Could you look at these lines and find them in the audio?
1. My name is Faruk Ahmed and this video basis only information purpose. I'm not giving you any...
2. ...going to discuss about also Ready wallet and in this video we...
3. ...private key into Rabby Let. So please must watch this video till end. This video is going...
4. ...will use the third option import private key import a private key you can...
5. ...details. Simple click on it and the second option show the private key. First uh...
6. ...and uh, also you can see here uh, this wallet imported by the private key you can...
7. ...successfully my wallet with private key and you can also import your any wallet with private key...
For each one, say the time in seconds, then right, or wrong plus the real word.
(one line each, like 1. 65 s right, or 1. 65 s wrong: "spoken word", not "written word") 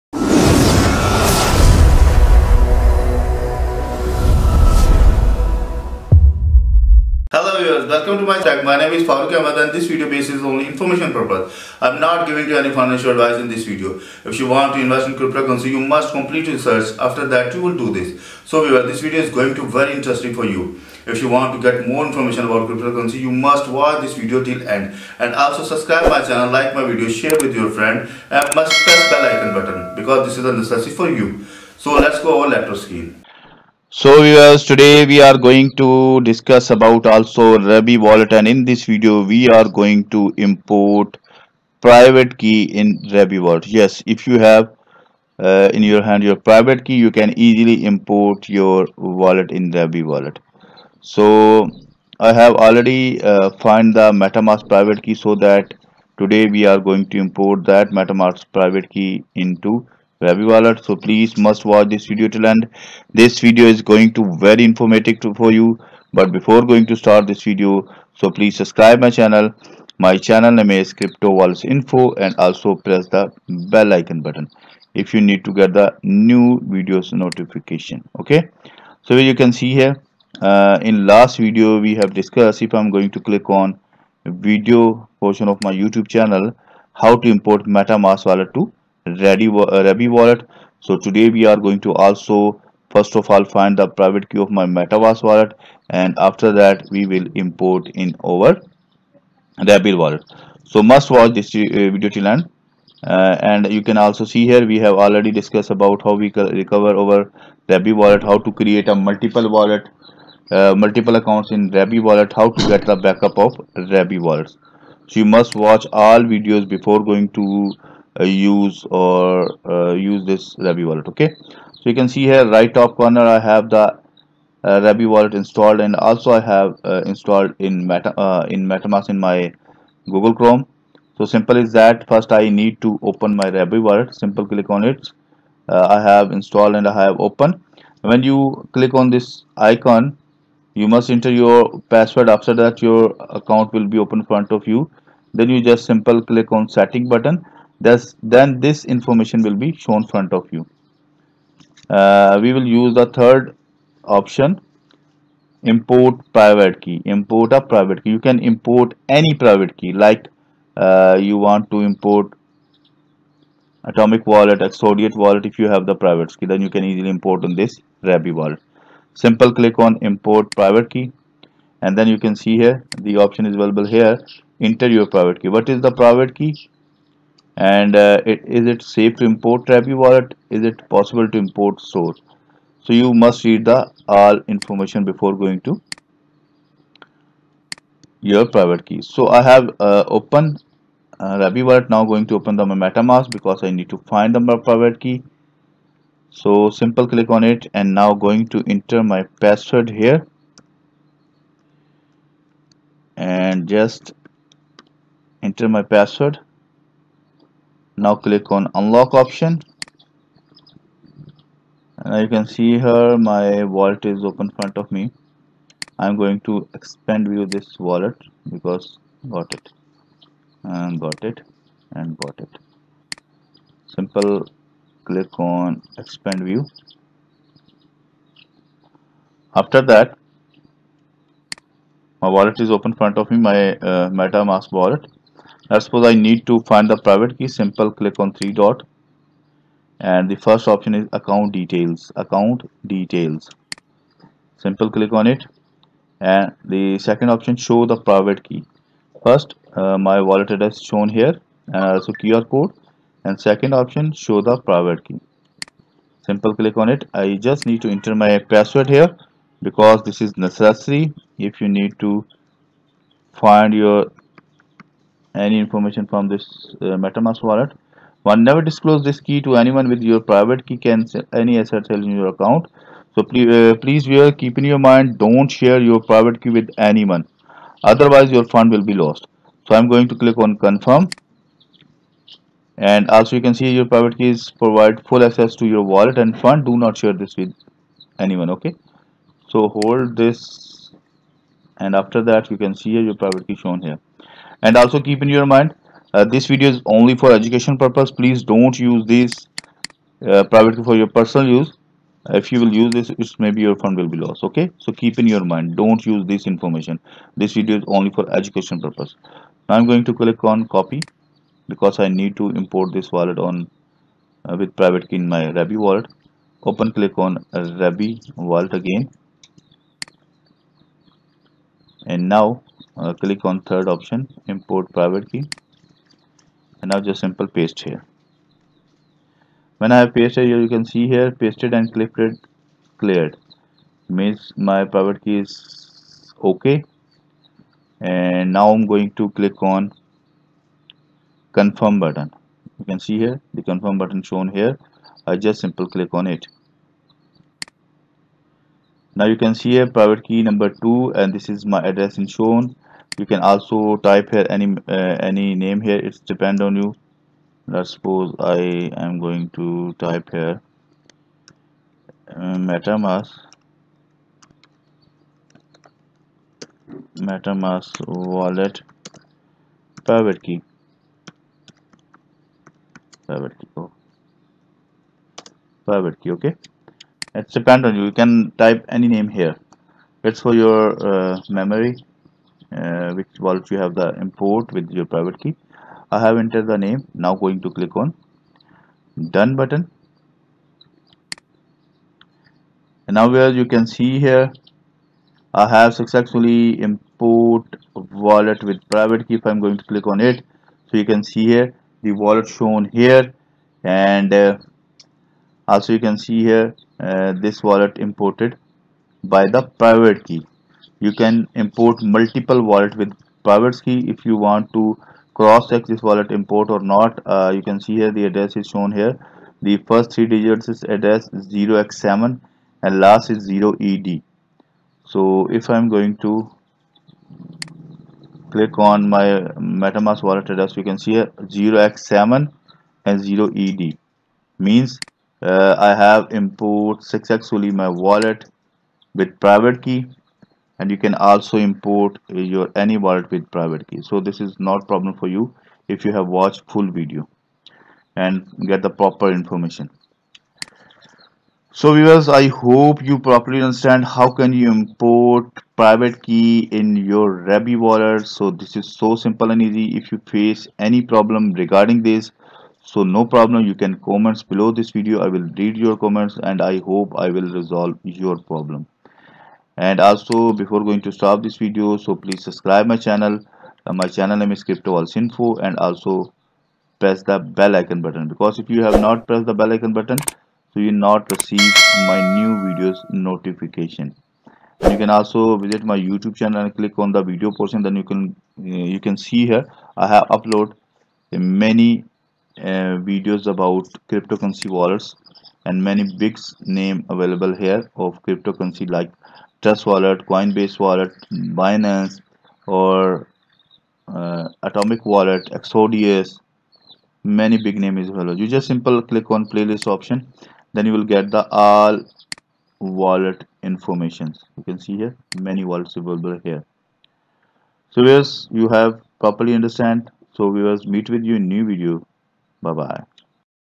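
1. 8 s right
2. 35 s wrong: "Rabby", not "Ready"
3. 58 s wrong: "Wallet", not "Let"
4. 152 s right
5. 242 s right
6. 403 s right
7. 437 s right.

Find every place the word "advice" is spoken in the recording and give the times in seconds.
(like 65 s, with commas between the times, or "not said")
13 s.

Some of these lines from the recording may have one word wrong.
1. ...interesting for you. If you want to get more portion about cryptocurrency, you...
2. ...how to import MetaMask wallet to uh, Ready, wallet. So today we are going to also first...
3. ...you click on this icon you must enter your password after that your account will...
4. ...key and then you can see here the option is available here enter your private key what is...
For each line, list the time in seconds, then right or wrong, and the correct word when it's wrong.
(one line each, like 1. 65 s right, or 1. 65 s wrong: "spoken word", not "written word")
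1. 19 s wrong: "information", not "portion"
2. 86 s right
3. 138 s right
4. 170 s right.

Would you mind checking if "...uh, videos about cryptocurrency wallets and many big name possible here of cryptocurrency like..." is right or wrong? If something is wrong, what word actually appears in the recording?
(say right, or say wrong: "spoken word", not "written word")
wrong: "available", not "possible".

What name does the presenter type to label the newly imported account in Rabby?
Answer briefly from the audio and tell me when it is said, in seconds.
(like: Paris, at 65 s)
MetaMask wallet private key, at 362 s.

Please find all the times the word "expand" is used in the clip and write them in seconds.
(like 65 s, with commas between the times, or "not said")
216 s, 225 s.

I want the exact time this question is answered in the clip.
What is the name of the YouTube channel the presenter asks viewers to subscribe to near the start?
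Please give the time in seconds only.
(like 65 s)
70 s.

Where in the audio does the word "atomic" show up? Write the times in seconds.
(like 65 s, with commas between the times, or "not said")
163 s, 504 s.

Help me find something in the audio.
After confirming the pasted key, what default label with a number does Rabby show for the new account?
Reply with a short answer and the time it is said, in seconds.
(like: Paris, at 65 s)
Private key number 2, at 349 s.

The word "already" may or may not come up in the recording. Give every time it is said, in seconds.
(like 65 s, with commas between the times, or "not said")
52 s, 104 s.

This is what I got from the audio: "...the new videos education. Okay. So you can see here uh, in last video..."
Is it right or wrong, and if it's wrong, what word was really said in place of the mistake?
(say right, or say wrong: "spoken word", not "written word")
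wrong: "notification", not "education".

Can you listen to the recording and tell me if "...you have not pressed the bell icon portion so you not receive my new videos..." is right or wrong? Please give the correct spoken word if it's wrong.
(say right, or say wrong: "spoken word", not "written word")
wrong: "button", not "portion".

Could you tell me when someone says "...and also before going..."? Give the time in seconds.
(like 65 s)
469 s.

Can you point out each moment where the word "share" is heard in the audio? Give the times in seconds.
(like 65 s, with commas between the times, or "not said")
27 s, 275 s, 286 s.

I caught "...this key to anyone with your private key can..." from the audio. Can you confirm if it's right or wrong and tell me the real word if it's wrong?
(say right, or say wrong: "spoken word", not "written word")
right.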